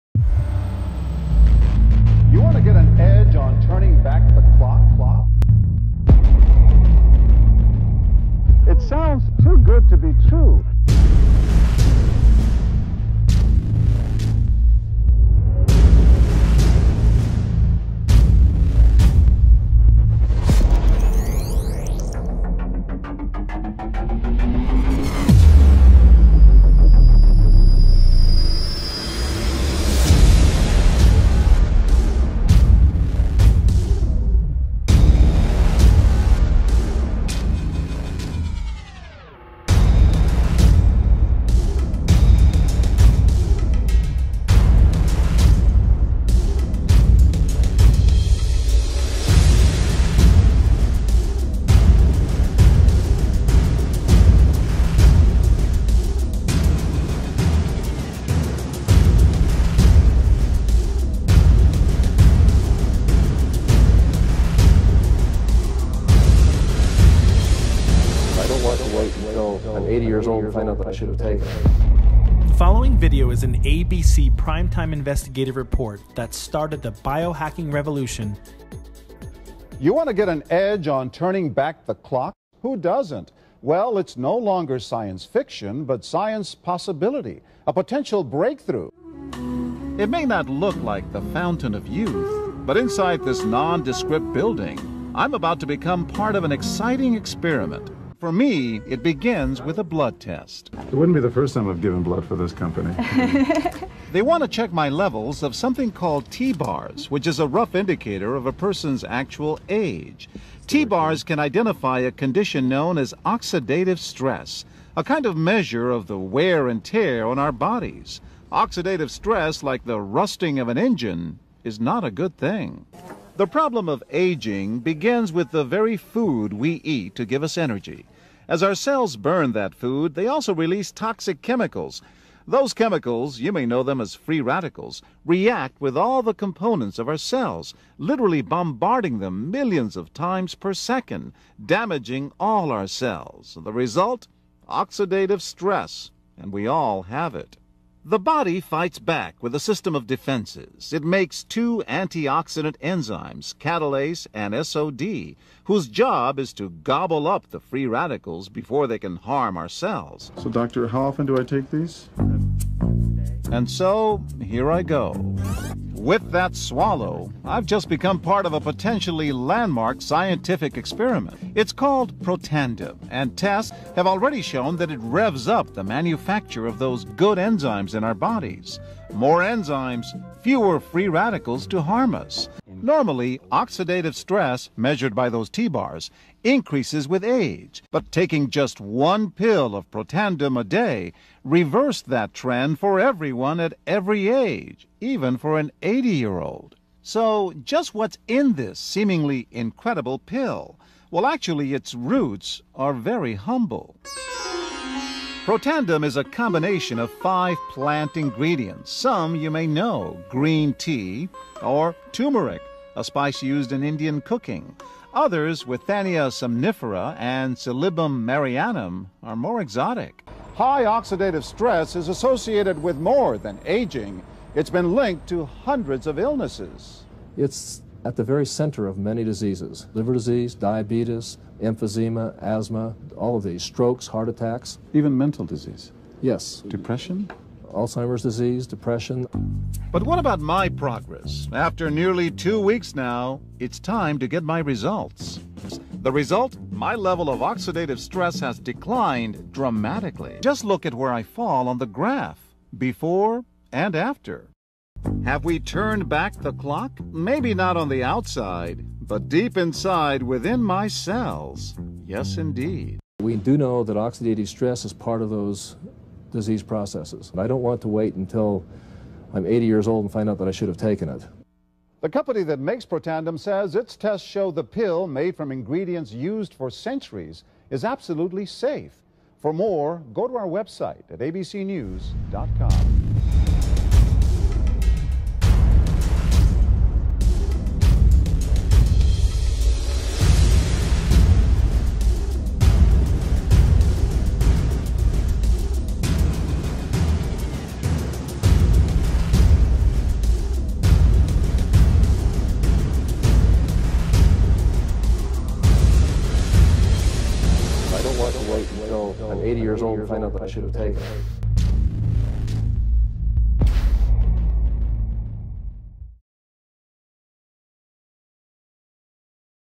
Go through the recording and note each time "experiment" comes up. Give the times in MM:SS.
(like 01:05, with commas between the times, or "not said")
01:37, 02:50.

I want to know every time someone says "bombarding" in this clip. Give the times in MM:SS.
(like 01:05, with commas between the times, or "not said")
02:18.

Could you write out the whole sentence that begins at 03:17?
So just what's in this seemingly incredible pill?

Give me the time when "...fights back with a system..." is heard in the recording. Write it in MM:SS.
02:28.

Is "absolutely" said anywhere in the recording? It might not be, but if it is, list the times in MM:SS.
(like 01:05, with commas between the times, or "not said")
04:37.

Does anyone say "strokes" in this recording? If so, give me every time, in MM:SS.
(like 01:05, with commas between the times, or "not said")
03:53.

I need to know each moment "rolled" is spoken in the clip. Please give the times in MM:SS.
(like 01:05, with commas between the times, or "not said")
not said.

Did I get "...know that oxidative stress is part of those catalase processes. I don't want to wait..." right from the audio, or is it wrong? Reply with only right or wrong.
wrong.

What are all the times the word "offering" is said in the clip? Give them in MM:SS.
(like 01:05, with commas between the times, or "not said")
not said.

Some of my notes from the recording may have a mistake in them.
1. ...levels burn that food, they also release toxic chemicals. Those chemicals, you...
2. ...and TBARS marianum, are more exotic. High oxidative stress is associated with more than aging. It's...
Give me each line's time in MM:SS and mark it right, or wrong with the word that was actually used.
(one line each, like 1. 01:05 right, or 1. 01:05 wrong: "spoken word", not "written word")
1. 02:08 wrong: "cells", not "levels"
2. 03:37 wrong: "Silybum", not "TBARS".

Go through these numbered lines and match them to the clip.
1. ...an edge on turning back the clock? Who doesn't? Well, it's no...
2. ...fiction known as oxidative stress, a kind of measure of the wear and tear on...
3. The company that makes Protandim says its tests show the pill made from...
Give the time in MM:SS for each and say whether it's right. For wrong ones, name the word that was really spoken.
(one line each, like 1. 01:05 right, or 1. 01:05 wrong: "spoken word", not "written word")
1. 01:20 right
2. 01:52 wrong: "condition", not "fiction"
3. 04:32 right.